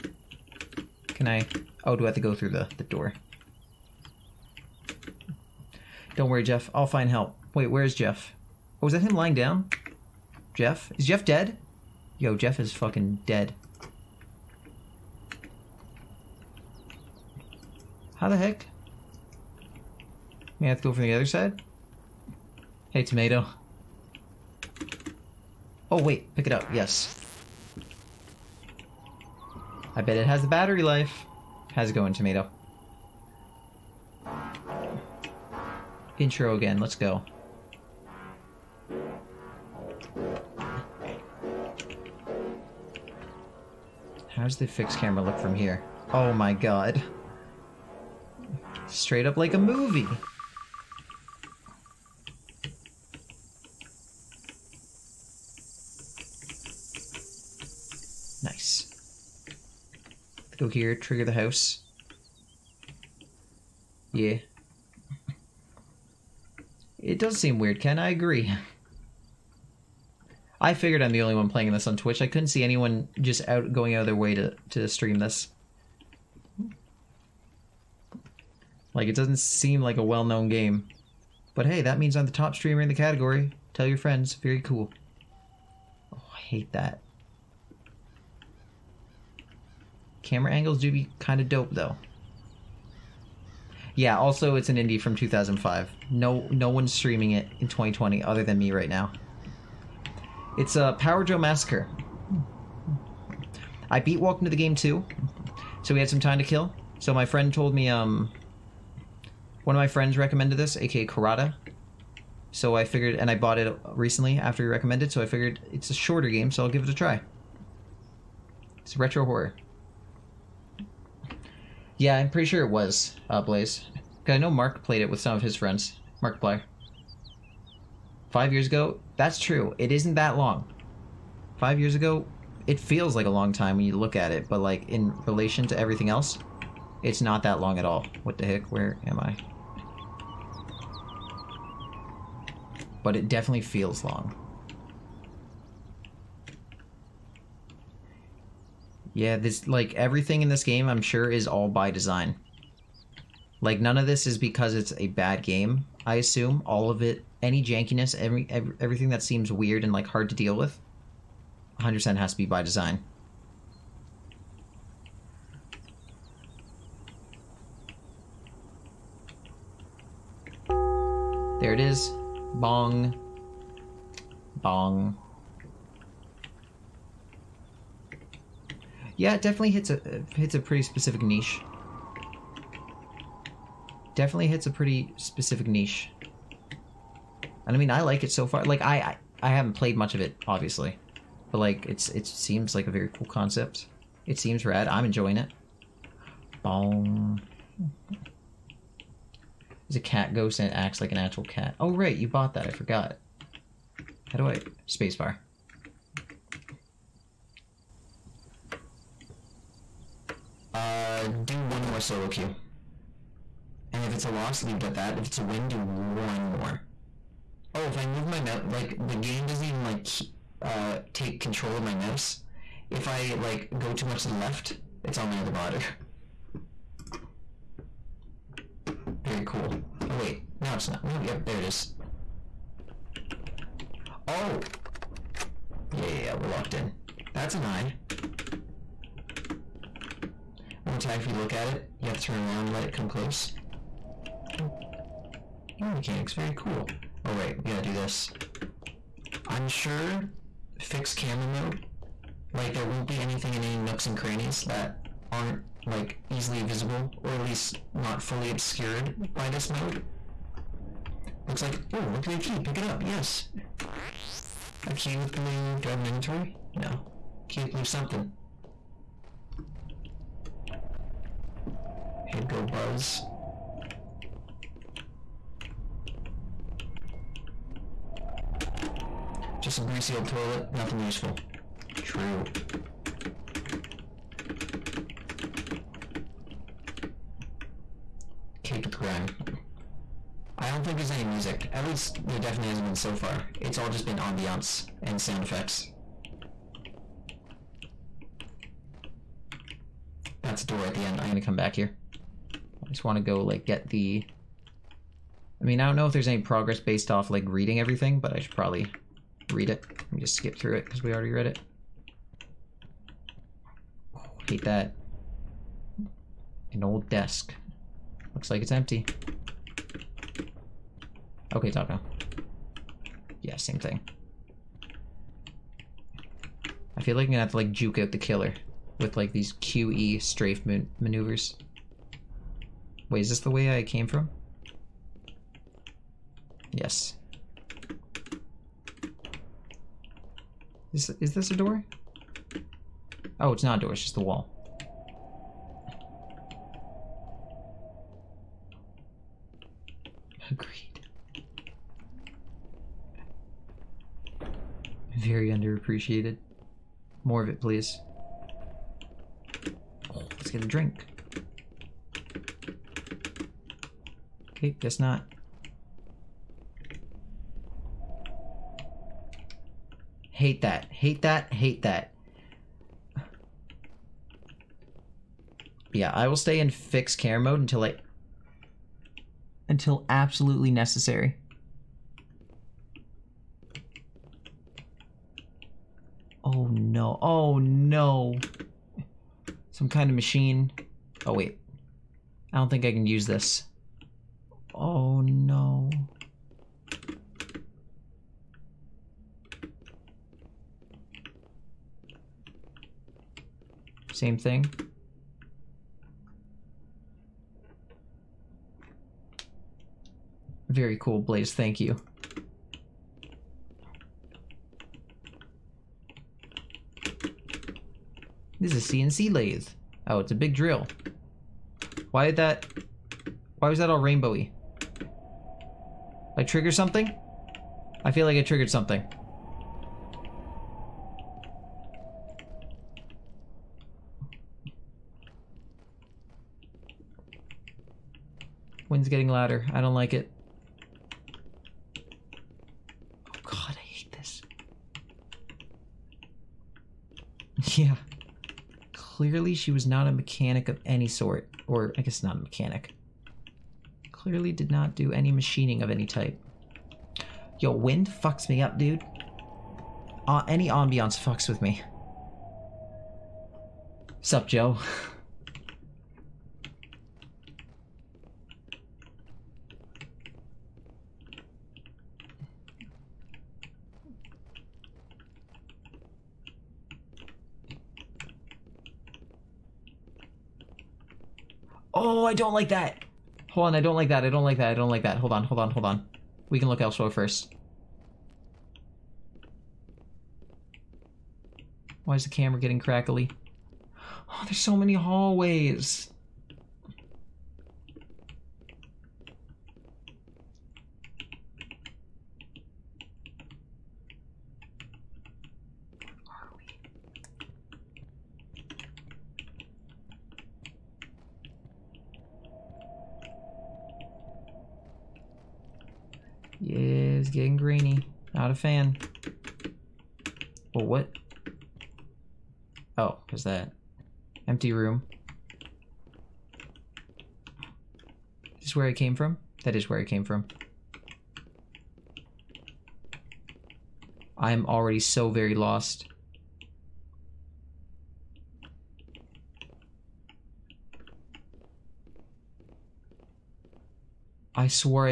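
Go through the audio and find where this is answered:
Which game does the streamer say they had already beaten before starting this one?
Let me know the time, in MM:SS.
01:44.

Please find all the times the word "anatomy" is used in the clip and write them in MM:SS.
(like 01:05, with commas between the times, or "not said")
not said.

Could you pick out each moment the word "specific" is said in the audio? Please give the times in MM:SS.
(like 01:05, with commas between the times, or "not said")
03:00, 03:05.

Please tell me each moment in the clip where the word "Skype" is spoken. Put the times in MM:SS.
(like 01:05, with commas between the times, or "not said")
not said.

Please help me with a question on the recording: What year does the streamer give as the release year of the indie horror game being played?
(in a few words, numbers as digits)
2005.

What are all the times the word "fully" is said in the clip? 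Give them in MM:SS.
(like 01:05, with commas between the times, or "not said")
04:18.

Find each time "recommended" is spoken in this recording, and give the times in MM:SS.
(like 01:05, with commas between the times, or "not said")
01:50, 01:54.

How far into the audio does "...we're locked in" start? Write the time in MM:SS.
03:56.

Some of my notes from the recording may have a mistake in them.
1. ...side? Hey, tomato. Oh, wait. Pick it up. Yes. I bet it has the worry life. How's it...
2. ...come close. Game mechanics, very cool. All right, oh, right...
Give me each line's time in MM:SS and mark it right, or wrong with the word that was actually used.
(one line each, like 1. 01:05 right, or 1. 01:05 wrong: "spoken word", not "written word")
1. 00:21 wrong: "battery", not "worry"
2. 04:02 right.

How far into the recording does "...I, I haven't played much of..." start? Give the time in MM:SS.
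03:08.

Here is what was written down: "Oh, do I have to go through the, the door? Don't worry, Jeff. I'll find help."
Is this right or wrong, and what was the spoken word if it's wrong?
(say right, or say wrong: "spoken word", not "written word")
right.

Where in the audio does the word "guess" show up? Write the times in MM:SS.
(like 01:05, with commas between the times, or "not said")
06:04, 07:32.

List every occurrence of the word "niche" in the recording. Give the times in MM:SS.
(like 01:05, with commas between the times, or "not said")
03:01, 03:05.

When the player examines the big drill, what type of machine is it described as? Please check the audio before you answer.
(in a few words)
CNC lathe.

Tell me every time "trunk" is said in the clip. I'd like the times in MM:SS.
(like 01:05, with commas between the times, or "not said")
not said.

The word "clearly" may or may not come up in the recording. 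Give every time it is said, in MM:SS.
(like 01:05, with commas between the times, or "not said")
07:28, 07:34.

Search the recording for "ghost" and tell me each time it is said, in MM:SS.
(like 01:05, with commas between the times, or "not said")
03:20.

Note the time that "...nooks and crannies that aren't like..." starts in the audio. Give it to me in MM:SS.
04:13.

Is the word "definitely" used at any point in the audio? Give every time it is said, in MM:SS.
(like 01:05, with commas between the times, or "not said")
02:23, 02:59, 03:04, 04:52.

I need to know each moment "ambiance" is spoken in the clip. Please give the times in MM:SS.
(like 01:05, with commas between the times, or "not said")
04:54, 07:40.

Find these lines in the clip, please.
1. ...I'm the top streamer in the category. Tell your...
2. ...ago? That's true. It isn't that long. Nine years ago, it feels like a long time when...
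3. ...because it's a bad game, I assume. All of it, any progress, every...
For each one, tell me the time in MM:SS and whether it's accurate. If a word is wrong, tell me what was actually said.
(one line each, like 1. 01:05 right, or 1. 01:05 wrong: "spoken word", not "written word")
1. 01:22 right
2. 02:08 wrong: "Five", not "Nine"
3. 02:34 wrong: "jankiness", not "progress".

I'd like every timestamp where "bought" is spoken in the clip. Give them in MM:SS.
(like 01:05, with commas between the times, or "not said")
01:53, 03:22.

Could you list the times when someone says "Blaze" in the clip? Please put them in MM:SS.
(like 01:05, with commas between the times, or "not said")
02:03, 06:51.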